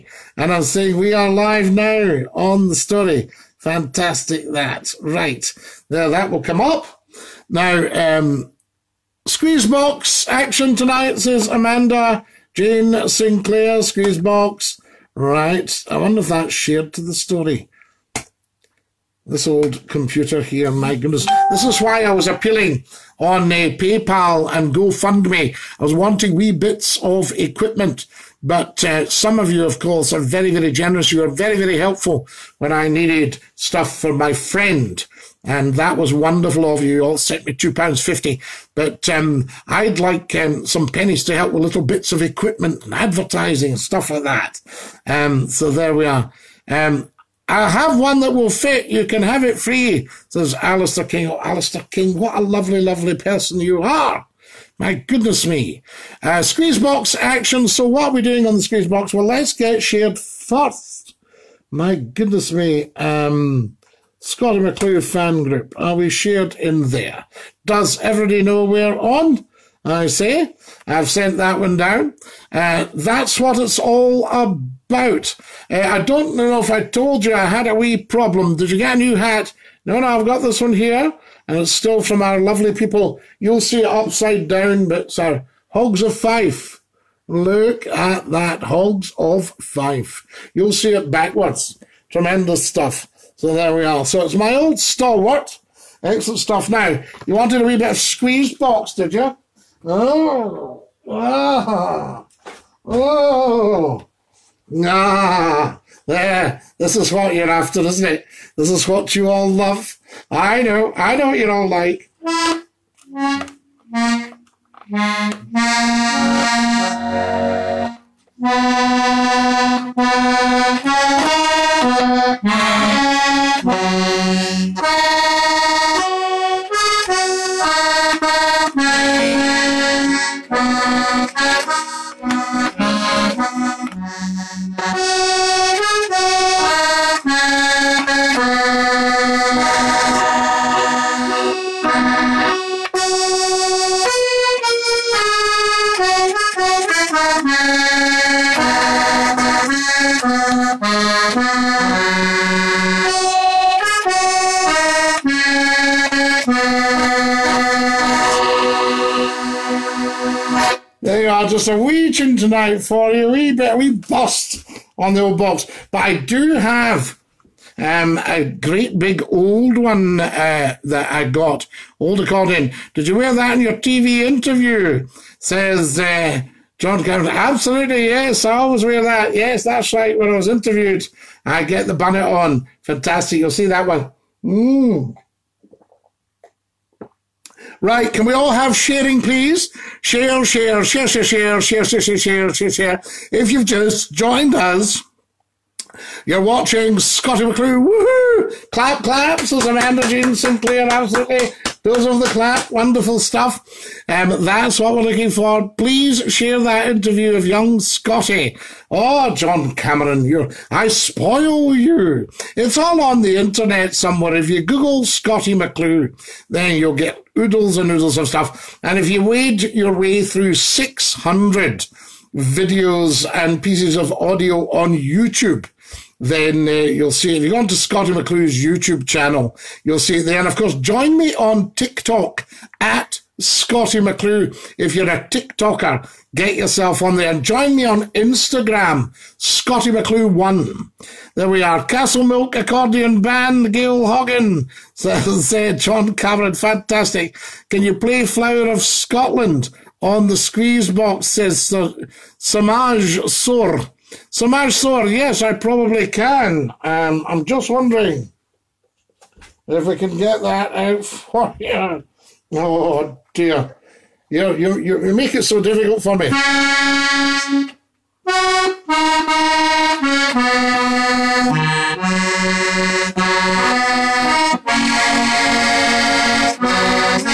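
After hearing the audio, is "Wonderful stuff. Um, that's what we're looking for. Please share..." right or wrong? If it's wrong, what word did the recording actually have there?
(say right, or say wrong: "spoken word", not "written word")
right.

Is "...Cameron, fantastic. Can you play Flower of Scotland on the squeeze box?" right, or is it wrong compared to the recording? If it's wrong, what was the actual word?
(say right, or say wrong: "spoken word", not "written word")
right.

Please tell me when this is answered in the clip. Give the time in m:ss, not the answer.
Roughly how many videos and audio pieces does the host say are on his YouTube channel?
3:40.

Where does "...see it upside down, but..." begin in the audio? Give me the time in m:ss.
1:23.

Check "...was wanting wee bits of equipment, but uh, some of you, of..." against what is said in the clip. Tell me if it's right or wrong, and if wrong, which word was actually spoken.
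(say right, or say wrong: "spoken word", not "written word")
right.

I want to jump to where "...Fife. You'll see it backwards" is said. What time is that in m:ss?
1:29.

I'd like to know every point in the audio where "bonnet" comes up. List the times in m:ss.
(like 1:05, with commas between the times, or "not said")
3:01.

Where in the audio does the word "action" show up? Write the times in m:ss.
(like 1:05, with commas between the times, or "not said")
0:10, 0:57.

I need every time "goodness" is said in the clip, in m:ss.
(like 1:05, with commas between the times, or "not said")
0:20, 0:54, 1:01.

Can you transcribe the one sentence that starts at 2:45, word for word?
But I do have um, a great big old one uh, that I got, old accordion.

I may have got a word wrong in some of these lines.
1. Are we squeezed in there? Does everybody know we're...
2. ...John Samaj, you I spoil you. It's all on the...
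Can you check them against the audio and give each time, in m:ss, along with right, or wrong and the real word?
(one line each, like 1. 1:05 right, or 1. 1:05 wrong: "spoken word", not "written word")
1. 1:05 wrong: "shared", not "squeezed"
2. 3:29 wrong: "Cameron", not "Samaj".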